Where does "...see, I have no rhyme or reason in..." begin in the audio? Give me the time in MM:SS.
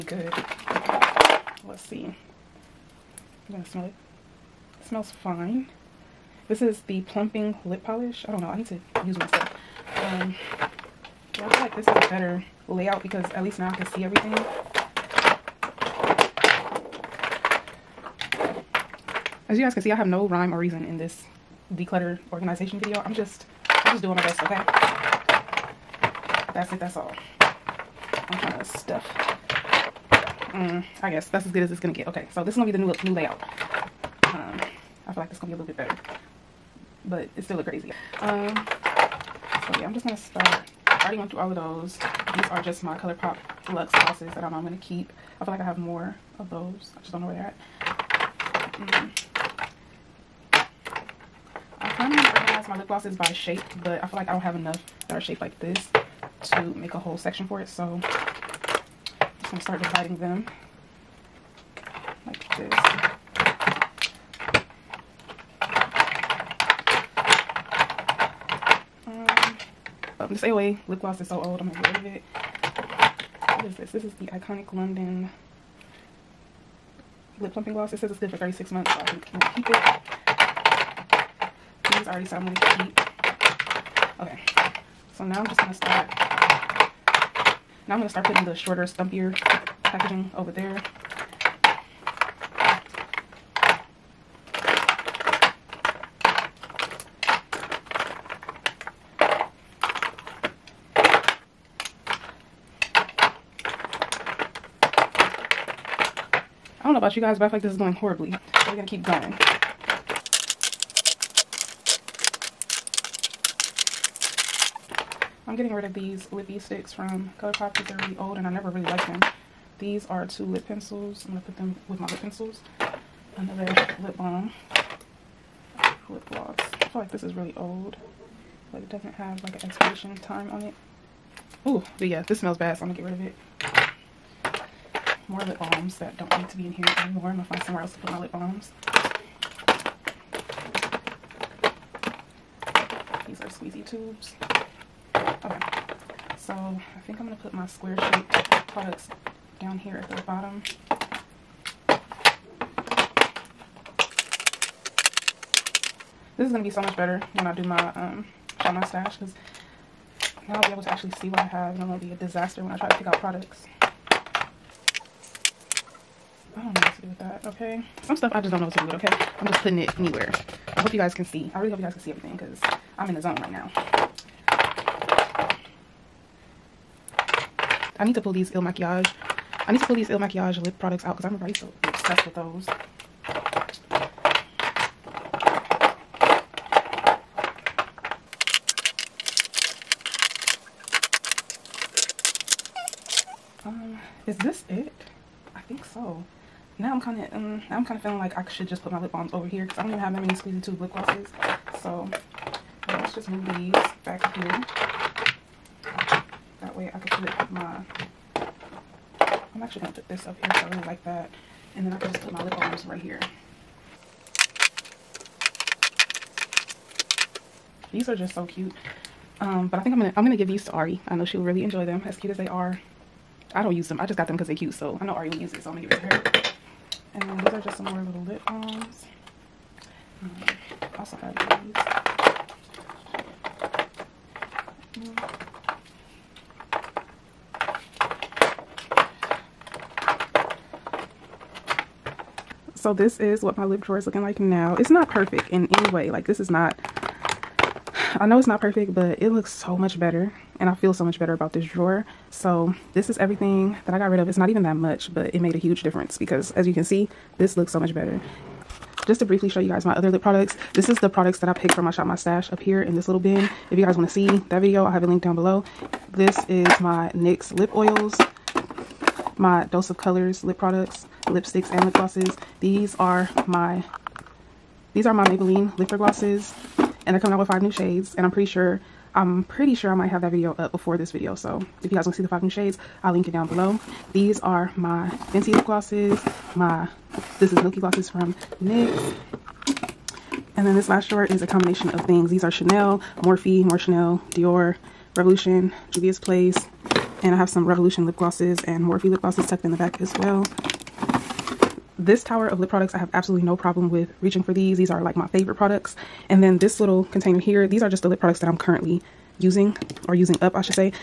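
00:19.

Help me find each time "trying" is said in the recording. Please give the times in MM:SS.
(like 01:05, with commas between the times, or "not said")
00:28, 00:52.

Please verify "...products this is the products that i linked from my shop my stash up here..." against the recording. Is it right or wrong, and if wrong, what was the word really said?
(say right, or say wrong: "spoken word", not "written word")
wrong: "picked", not "linked".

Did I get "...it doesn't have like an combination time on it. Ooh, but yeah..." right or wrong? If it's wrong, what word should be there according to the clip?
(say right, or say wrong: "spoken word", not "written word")
wrong: "expiration", not "combination".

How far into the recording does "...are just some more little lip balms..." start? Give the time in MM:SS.
03:47.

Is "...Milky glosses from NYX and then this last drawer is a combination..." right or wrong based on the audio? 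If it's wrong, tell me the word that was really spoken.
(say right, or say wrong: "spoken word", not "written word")
right.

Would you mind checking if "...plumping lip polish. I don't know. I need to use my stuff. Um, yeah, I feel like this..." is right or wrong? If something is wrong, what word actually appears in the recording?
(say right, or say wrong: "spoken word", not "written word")
right.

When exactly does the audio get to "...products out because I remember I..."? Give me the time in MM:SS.
03:00.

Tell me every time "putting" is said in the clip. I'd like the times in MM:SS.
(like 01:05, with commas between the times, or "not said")
01:28, 02:49.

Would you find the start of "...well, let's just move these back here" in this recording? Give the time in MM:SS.
03:22.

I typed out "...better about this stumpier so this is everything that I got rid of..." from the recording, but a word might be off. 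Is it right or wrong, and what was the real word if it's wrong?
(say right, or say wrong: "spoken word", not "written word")
wrong: "drawer", not "stumpier".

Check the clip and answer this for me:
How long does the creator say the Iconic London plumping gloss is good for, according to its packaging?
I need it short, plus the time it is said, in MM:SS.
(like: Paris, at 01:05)
36 months, at 01:18.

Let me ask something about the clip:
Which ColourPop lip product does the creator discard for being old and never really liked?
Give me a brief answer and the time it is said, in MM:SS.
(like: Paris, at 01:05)
Lippie Stix, at 01:56.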